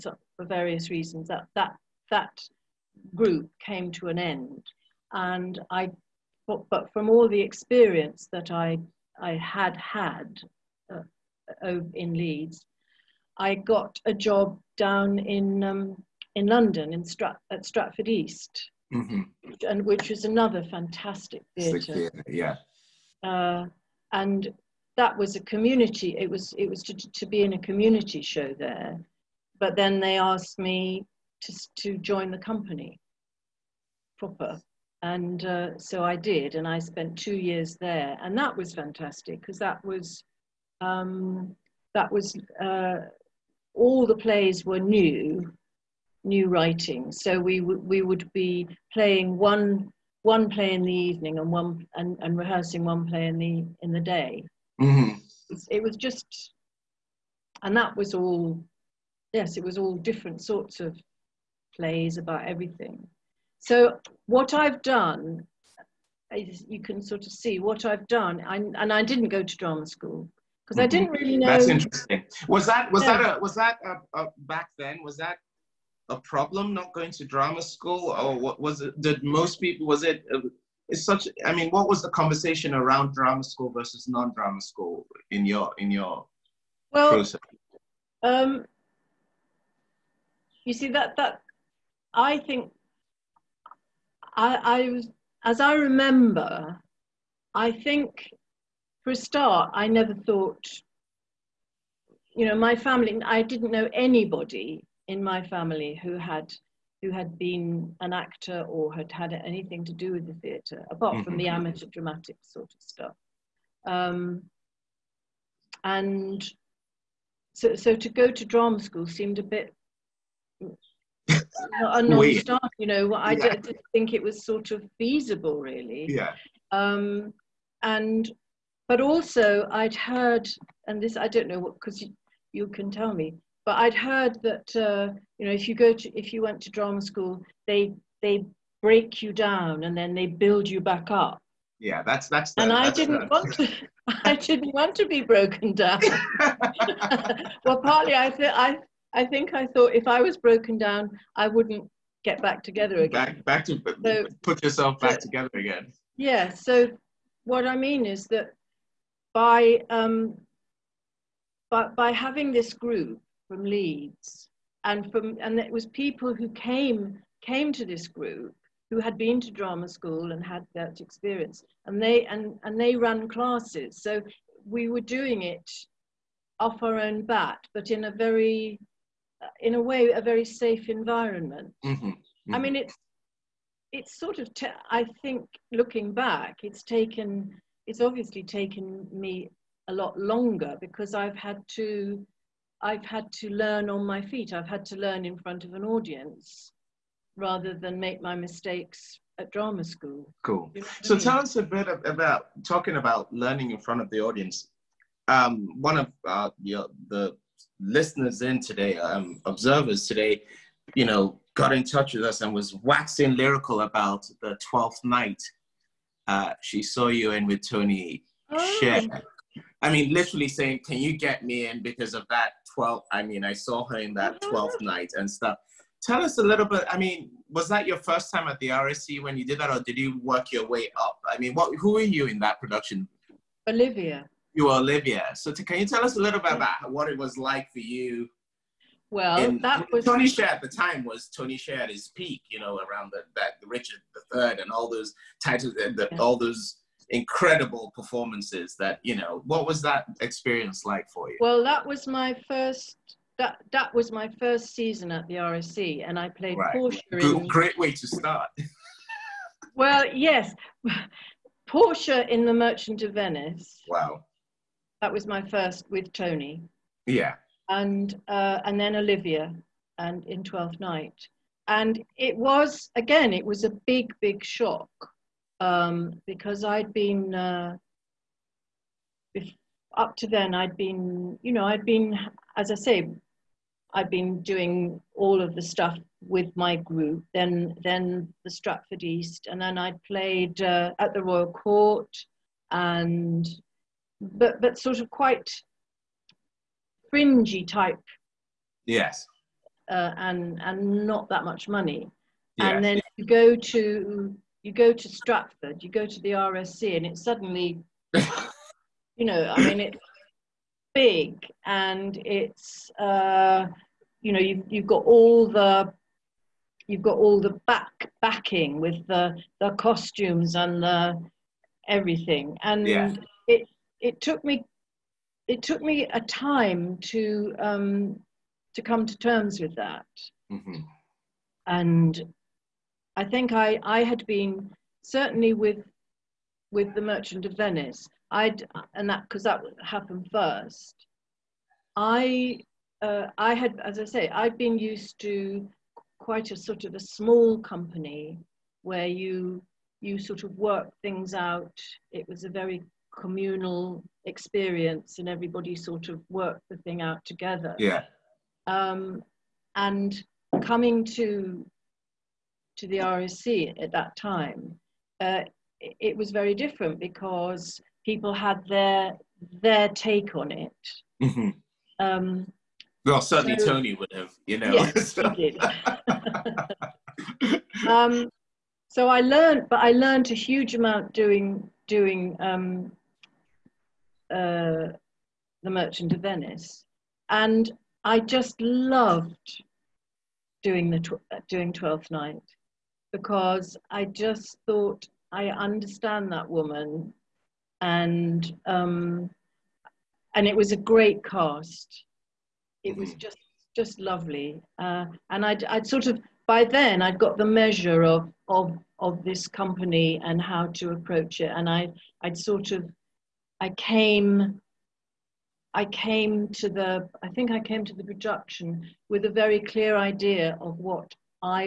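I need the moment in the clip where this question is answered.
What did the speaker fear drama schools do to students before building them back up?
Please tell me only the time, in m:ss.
2:18.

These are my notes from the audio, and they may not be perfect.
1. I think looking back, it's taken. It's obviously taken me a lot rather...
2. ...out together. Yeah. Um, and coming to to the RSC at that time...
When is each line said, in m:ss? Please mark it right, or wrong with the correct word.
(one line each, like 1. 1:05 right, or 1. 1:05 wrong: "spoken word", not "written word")
1. 3:04 wrong: "longer", not "rather"
2. 5:57 right.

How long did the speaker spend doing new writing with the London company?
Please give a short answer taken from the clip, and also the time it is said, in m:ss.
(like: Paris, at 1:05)
2 years, at 0:37.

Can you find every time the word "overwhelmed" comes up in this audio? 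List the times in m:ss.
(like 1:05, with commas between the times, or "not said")
not said.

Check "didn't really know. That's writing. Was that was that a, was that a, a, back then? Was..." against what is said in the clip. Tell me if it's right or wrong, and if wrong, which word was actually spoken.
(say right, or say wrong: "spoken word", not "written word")
wrong: "interesting", not "writing".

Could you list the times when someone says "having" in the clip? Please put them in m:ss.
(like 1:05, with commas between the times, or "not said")
2:42.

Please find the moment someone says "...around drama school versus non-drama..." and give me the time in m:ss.
1:22.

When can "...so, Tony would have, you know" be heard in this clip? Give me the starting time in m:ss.
6:13.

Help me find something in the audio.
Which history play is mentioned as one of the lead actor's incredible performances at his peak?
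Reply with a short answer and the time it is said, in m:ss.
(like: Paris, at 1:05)
Richard the Third, at 4:03.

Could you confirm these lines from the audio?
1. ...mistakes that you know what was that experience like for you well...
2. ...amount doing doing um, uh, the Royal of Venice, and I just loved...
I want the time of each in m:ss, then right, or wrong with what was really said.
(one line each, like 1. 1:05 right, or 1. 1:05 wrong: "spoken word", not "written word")
1. 4:07 wrong: "performances", not "mistakes"
2. 6:20 wrong: "Merchant", not "Royal".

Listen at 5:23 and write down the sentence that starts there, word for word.
it it took me it took me a time to um, to come to terms with that mm-hmm.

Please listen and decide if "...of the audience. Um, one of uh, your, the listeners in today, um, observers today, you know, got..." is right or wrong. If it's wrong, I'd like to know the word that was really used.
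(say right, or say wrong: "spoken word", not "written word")
right.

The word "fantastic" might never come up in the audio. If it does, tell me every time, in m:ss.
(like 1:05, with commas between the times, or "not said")
0:20, 0:38.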